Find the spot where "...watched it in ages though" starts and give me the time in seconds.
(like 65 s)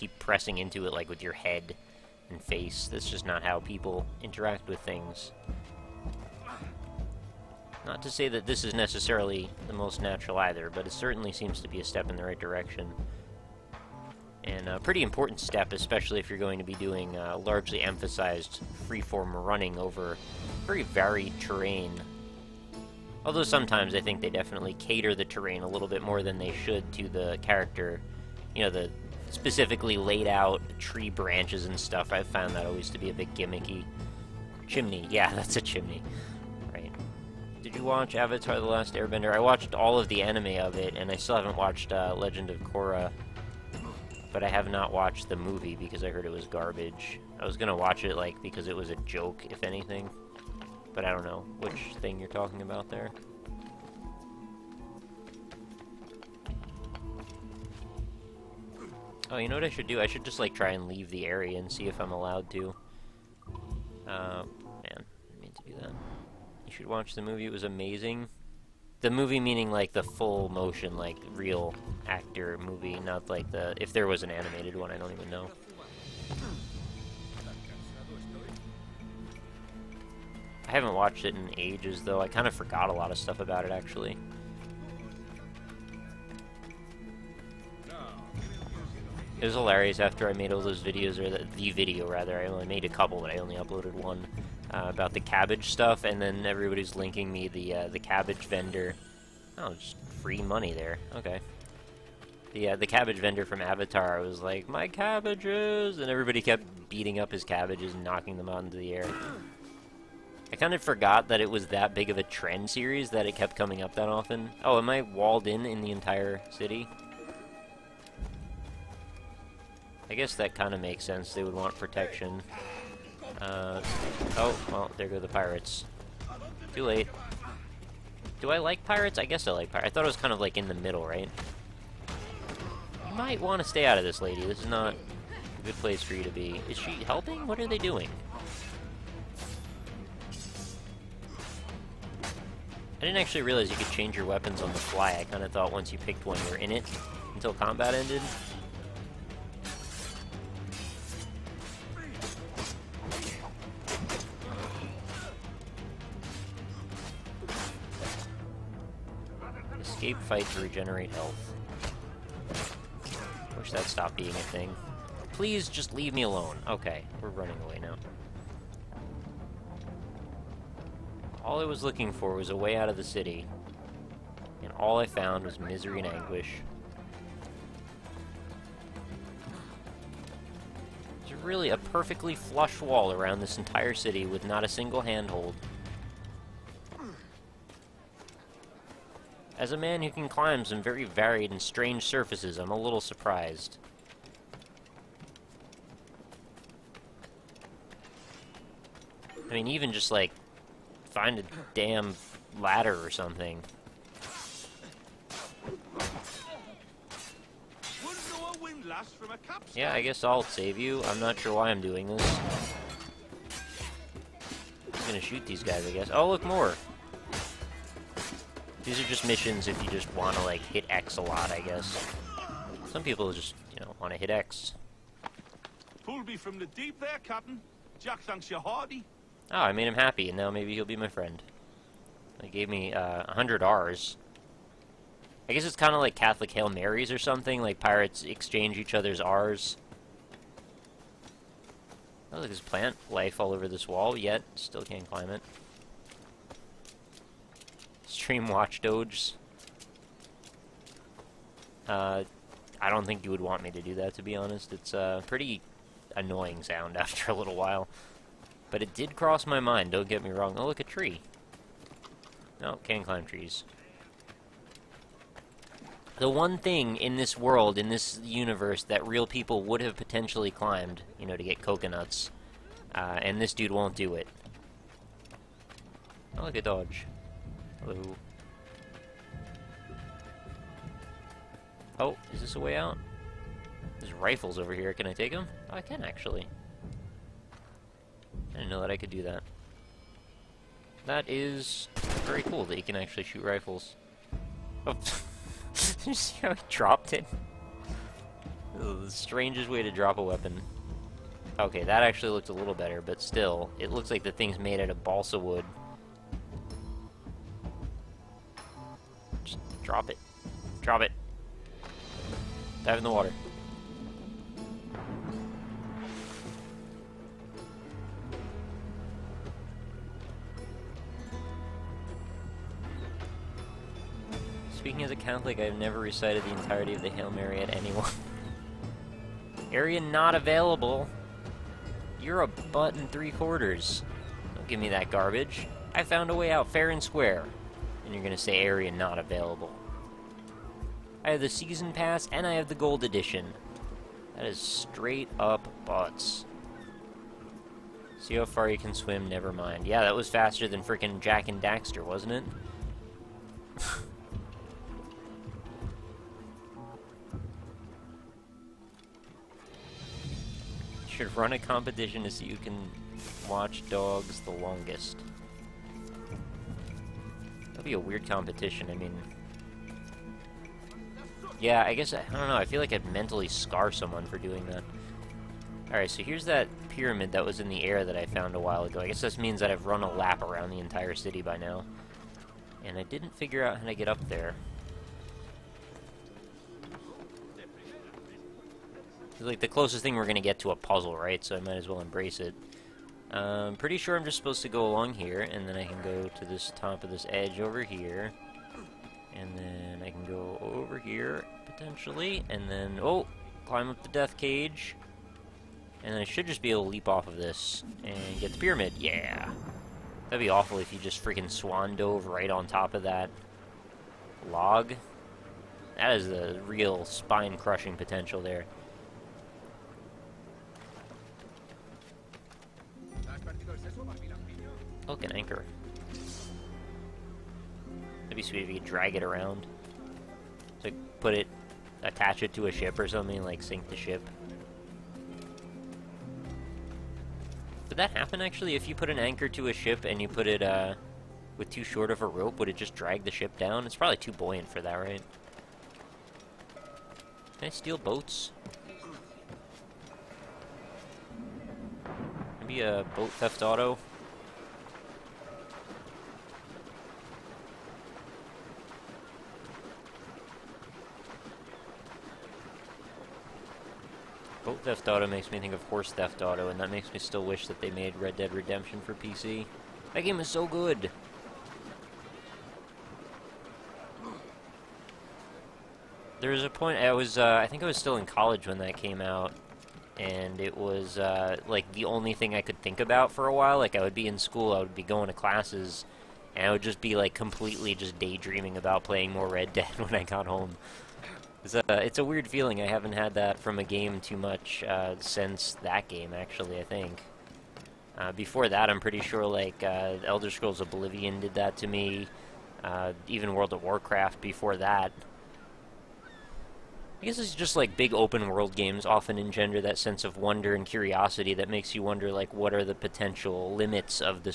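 80 s.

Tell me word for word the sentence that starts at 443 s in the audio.
It's probably too buoyant for that, right?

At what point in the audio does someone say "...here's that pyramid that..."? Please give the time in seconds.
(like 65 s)
376 s.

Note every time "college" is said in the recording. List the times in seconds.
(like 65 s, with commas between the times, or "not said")
478 s.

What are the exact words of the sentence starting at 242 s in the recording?
Oh, look, there's plant life all over this wall, yet still can't climb it stream Watch Dogs.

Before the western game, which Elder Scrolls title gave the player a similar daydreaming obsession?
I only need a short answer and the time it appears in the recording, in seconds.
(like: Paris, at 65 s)
Oblivion, at 500 s.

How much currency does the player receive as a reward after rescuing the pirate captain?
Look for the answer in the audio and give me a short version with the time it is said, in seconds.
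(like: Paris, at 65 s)
100, at 233 s.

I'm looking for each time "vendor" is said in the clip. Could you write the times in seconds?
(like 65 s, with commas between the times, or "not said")
98 s, 103 s.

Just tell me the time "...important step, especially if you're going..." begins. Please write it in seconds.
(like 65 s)
15 s.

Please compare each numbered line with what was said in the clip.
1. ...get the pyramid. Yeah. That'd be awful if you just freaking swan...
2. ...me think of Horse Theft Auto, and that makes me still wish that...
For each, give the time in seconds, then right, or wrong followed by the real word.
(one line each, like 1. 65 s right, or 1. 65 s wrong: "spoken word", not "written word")
1. 408 s right
2. 465 s right.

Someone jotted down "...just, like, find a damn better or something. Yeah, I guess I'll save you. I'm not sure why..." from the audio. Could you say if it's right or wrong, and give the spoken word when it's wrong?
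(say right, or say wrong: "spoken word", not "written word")
wrong: "ladder", not "better".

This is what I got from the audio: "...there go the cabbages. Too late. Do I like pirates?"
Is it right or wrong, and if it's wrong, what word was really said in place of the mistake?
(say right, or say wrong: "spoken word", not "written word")
wrong: "pirates", not "cabbages".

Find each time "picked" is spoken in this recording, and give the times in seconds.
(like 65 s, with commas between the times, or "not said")
145 s.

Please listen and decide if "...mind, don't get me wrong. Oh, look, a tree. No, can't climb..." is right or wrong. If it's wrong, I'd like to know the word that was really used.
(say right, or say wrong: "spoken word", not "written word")
right.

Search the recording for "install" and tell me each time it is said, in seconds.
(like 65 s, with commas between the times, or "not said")
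not said.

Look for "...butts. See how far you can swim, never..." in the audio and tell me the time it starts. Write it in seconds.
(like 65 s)
345 s.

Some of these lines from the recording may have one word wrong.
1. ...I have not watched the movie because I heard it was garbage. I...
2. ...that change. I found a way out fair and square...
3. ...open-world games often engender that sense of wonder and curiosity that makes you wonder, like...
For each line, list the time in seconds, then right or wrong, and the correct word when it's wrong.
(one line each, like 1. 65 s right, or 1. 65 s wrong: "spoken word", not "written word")
1. 44 s right
2. 334 s wrong: "garbage", not "change"
3. 508 s right.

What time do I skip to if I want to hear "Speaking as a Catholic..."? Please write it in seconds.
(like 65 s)
324 s.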